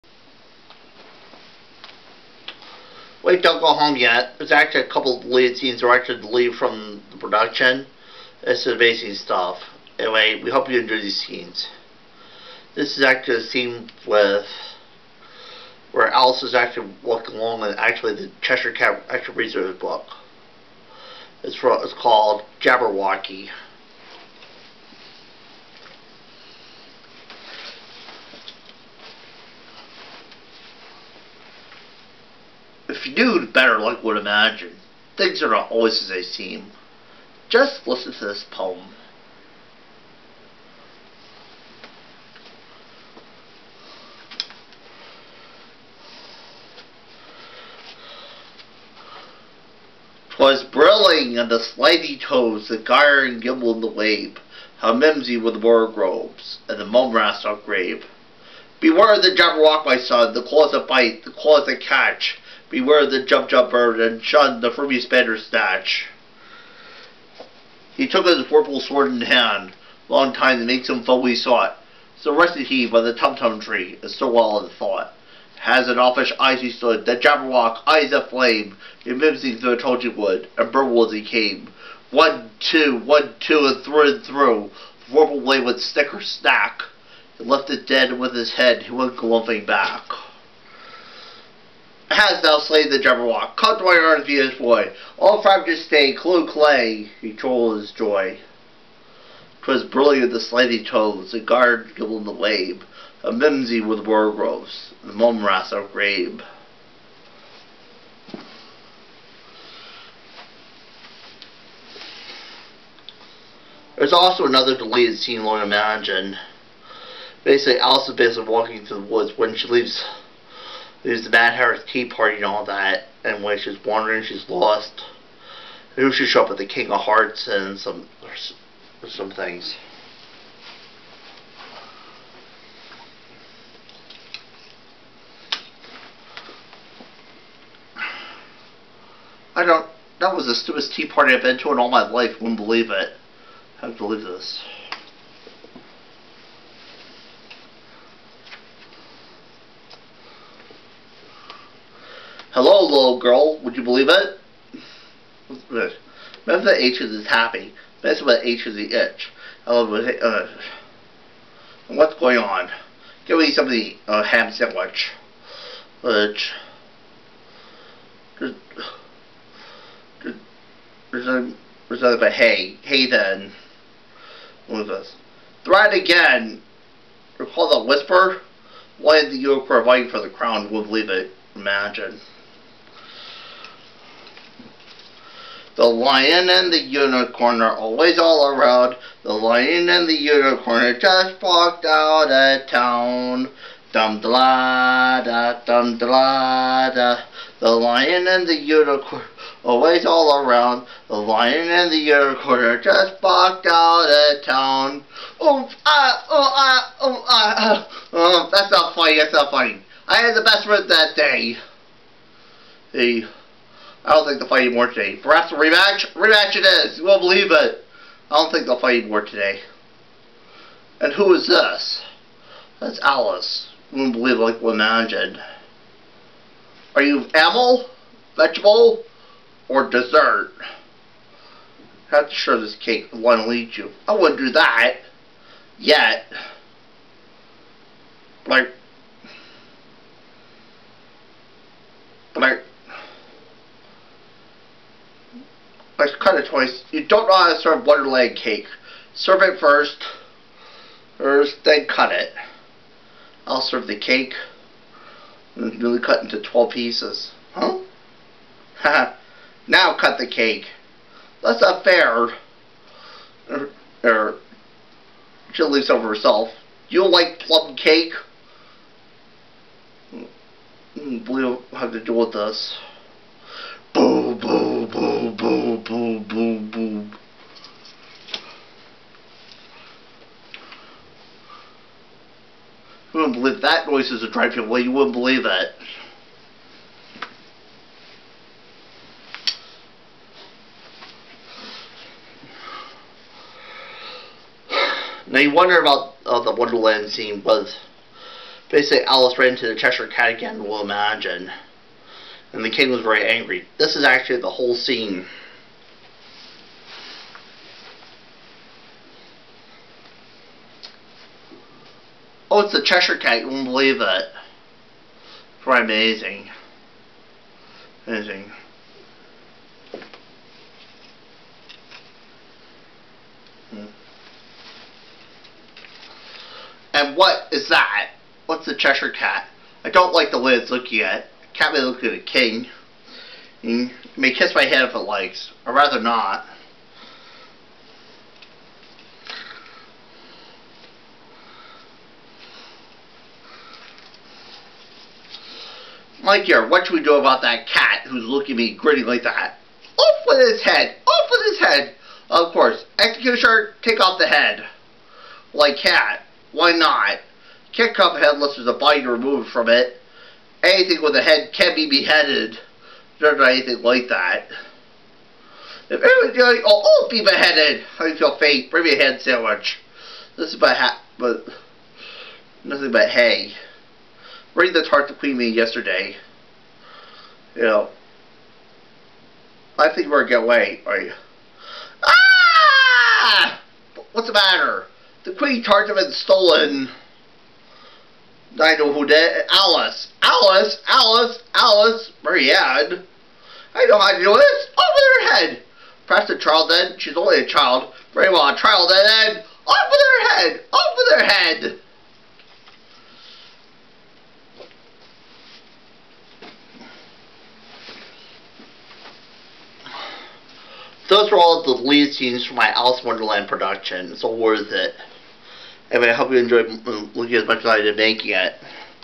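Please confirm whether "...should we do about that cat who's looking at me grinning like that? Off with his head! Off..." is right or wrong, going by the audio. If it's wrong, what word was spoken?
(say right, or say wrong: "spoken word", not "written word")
right.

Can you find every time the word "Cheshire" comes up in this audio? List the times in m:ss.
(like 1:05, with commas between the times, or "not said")
0:18, 4:59, 5:12, 5:28.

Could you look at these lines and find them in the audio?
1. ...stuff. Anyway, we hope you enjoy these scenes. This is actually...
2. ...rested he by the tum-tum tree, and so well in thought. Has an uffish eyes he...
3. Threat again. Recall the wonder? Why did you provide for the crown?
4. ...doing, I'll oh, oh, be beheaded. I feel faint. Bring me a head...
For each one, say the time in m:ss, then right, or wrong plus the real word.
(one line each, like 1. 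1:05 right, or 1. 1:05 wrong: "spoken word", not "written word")
1. 0:09 right
2. 1:12 right
3. 2:55 wrong: "whisper", not "wonder"
4. 6:06 right.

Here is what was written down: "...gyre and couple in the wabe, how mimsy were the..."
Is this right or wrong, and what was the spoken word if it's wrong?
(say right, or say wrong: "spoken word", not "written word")
wrong: "gimble", not "couple".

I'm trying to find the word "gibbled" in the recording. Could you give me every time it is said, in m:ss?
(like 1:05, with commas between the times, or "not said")
1:41.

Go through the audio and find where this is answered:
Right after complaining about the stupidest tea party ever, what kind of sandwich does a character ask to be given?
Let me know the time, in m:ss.
2:44.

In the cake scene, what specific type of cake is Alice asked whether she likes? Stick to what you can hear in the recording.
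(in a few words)
plum cake.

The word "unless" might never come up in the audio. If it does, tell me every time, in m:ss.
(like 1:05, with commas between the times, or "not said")
5:58.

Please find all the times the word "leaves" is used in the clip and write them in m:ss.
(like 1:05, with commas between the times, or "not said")
1:59, 3:00, 4:25.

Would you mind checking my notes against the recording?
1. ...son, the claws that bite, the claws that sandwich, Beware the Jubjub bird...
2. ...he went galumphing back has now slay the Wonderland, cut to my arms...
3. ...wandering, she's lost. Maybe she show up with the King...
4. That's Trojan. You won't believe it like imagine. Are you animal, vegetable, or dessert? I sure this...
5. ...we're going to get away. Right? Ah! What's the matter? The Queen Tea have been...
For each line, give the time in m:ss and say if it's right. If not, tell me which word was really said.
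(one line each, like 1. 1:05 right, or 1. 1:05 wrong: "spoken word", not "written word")
1. 0:59 wrong: "catch", not "sandwich"
2. 1:28 wrong: "Jabberwock", not "Wonderland"
3. 2:03 right
4. 3:42 wrong: "Alice", not "Trojan"
5. 6:20 wrong: "Tart", not "Tea".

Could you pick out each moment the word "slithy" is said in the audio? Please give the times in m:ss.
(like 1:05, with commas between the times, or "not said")
0:51, 1:40.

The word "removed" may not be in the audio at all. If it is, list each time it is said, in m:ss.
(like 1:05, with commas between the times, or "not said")
5:59.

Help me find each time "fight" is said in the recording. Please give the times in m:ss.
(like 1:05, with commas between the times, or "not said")
3:34, 3:38.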